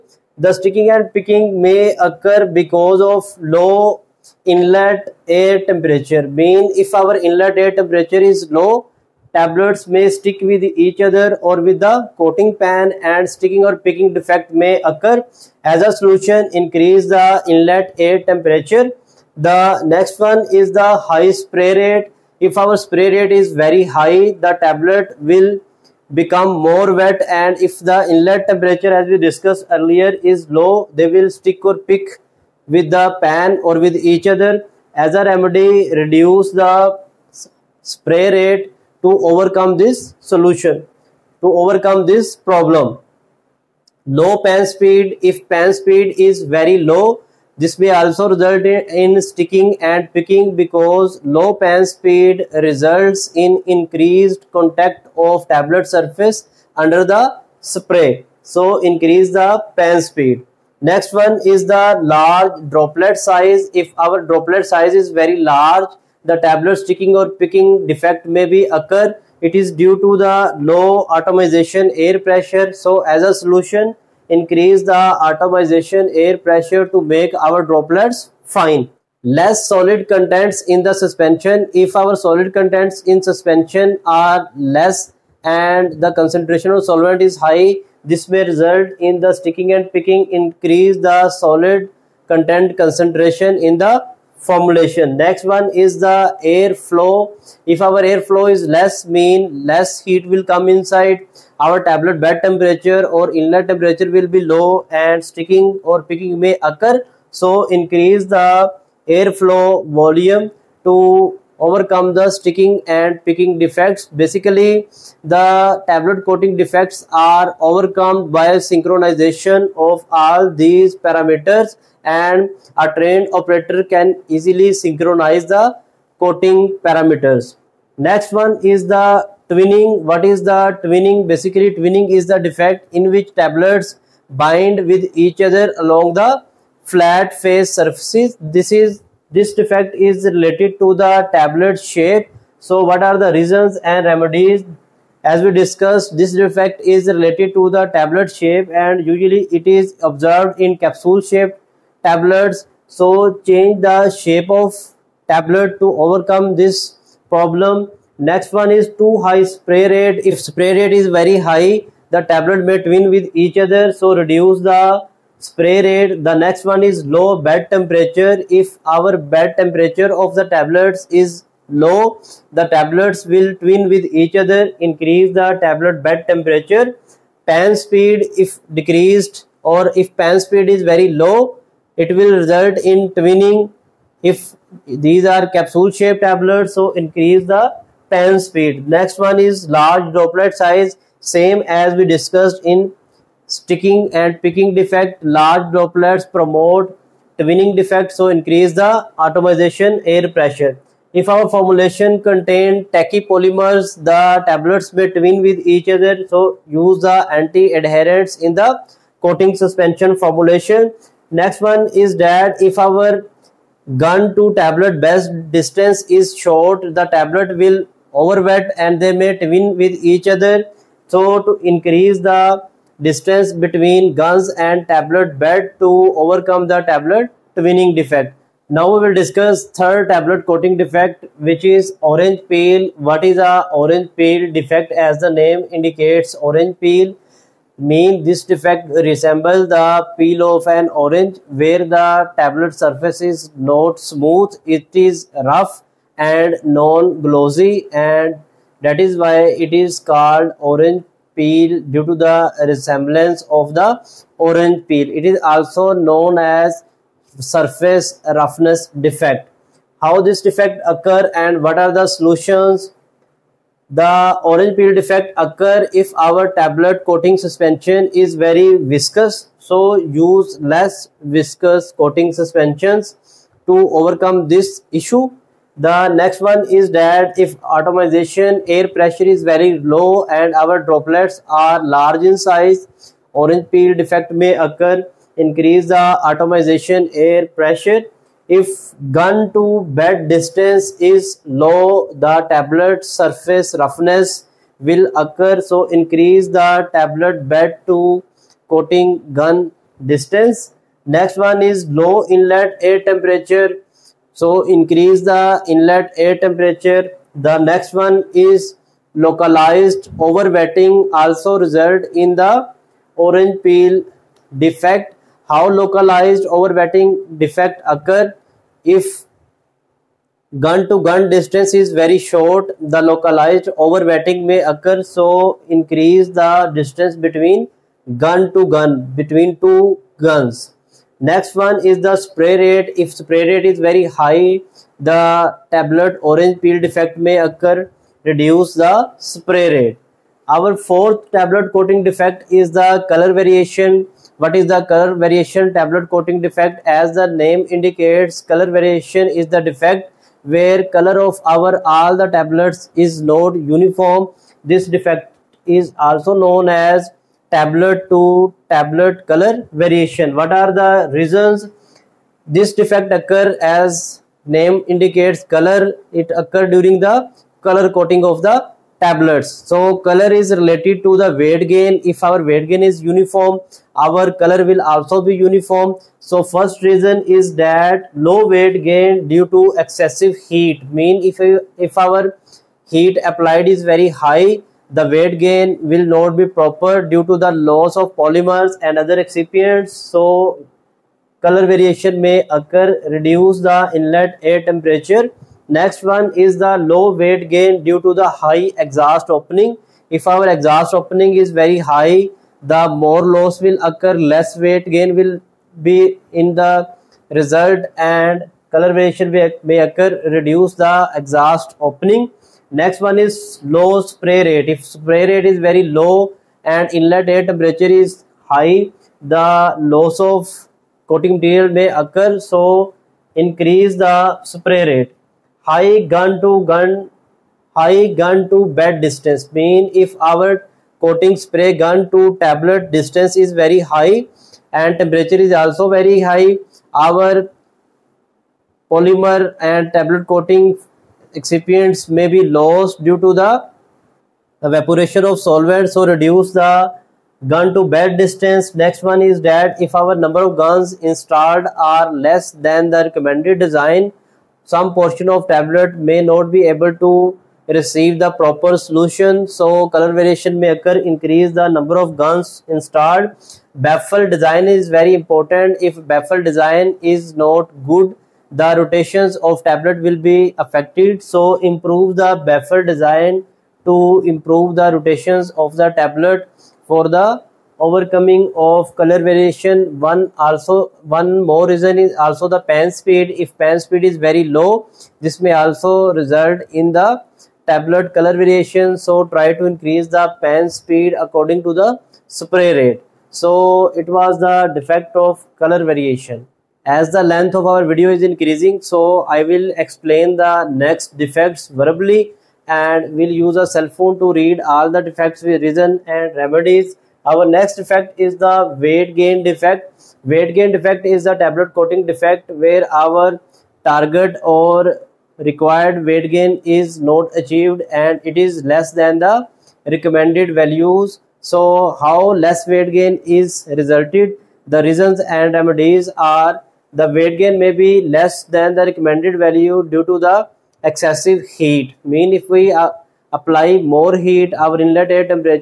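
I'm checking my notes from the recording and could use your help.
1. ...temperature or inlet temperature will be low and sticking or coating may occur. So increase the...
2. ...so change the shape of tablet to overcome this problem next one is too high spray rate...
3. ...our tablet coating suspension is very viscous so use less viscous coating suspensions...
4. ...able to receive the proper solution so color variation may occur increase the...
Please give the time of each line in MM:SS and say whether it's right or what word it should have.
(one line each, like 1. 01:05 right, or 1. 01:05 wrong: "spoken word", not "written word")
1. 01:42 wrong: "picking", not "coating"
2. 02:32 right
3. 04:26 right
4. 07:36 right.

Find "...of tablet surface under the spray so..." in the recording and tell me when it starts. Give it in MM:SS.
00:55.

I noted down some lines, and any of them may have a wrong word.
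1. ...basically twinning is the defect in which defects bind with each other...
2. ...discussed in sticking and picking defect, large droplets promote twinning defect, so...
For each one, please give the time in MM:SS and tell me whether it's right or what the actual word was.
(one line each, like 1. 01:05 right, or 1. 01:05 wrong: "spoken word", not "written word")
1. 02:11 wrong: "tablets", not "defects"
2. 03:12 right.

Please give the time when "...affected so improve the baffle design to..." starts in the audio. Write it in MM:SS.
07:50.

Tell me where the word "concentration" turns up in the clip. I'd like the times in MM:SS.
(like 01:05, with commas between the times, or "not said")
01:26, 01:32.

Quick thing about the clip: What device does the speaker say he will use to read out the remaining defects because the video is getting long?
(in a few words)
Cell phone.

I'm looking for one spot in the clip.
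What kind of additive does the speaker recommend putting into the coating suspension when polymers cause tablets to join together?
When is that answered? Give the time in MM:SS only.
03:27.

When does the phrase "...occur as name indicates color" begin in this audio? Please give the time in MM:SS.
06:03.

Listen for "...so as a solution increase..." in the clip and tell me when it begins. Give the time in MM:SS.
01:12.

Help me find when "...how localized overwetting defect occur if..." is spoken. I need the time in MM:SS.
05:15.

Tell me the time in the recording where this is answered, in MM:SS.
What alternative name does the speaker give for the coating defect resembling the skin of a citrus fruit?
04:17.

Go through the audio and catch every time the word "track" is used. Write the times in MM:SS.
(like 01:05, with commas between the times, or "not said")
not said.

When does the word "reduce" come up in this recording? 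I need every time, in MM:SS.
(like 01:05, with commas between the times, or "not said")
00:35, 02:44, 05:38, 06:33, 06:50, 07:26.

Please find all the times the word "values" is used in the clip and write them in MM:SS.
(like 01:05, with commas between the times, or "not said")
08:40, 08:49.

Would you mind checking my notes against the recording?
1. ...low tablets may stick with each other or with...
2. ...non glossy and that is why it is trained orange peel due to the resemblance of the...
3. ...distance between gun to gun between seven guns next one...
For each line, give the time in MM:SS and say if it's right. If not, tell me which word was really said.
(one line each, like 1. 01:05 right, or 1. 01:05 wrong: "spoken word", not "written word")
1. 00:08 right
2. 04:06 wrong: "called", not "trained"
3. 05:26 wrong: "two", not "seven".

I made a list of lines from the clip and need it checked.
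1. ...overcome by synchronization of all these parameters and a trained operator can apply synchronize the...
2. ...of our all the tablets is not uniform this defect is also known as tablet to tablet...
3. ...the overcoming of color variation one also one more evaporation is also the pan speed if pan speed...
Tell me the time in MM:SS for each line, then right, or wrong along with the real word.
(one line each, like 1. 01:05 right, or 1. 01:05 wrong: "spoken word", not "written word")
1. 01:57 wrong: "easily", not "apply"
2. 05:51 right
3. 07:57 wrong: "reason", not "evaporation".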